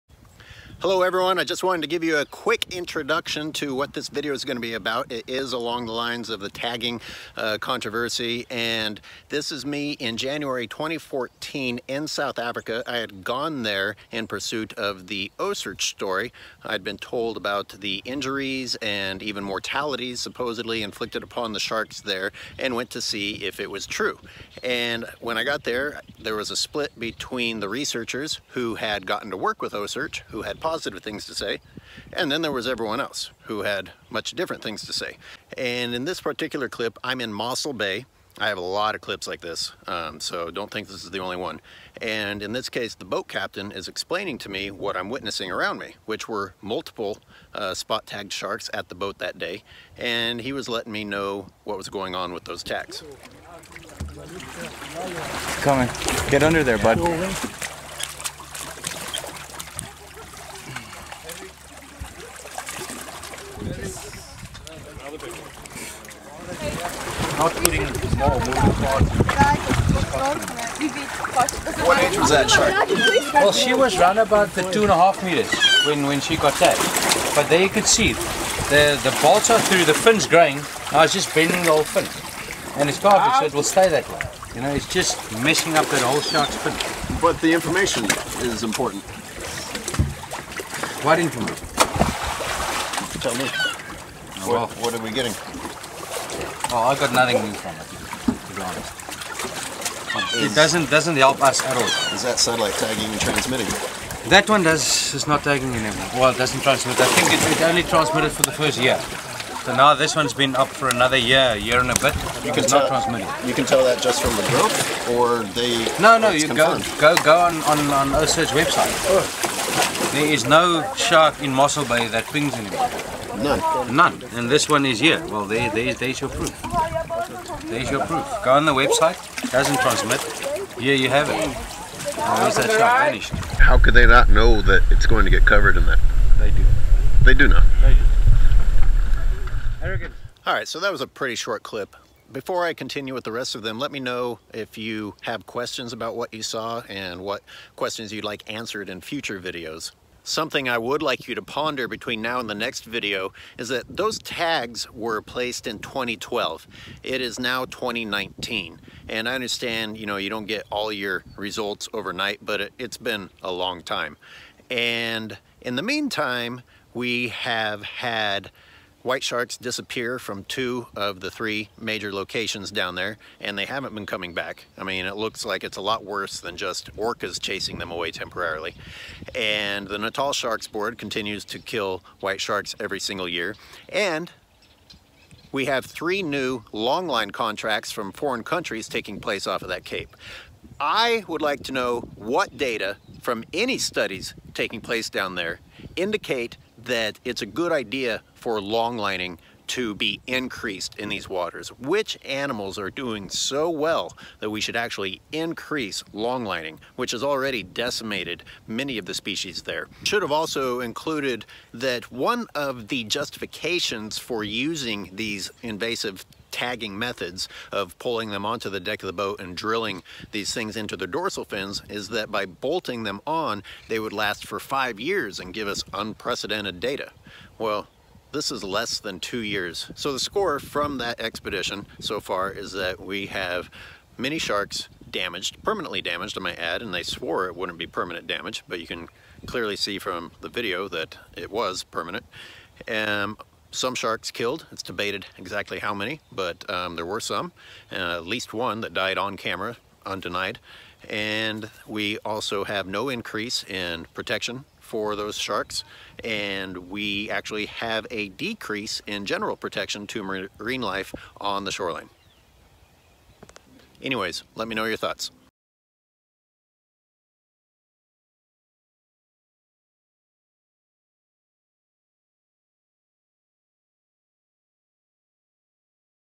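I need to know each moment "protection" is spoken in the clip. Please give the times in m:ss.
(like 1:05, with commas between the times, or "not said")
4:14, 4:19.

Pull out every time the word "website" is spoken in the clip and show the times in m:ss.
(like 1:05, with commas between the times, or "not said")
1:58, 2:08.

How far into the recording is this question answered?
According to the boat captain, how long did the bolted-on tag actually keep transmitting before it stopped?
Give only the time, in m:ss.
1:48.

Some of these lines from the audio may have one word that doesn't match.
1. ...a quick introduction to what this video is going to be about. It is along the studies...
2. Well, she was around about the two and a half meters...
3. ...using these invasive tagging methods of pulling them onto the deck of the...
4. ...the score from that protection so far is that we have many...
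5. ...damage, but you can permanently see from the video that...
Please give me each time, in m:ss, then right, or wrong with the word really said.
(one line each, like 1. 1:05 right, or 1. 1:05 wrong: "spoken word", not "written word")
1. 0:02 wrong: "lines", not "studies"
2. 1:13 right
3. 3:34 right
4. 3:50 wrong: "expedition", not "protection"
5. 3:58 wrong: "clearly", not "permanently".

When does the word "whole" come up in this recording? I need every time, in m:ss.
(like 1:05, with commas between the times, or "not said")
1:21, 1:26.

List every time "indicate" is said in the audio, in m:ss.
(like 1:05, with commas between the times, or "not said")
3:15.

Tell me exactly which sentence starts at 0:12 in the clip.
I had gone there in pursuit of the OCEARCH story.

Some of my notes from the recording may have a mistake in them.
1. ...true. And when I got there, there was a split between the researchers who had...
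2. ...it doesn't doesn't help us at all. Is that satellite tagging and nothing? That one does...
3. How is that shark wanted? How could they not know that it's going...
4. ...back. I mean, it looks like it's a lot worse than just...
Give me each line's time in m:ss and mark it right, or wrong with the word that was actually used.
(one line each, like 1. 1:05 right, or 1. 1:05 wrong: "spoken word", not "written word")
1. 0:23 right
2. 1:40 wrong: "transmitting", not "nothing"
3. 2:12 wrong: "vanished", not "wanted"
4. 2:54 right.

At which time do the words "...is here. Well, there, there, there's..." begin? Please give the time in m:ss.
2:04.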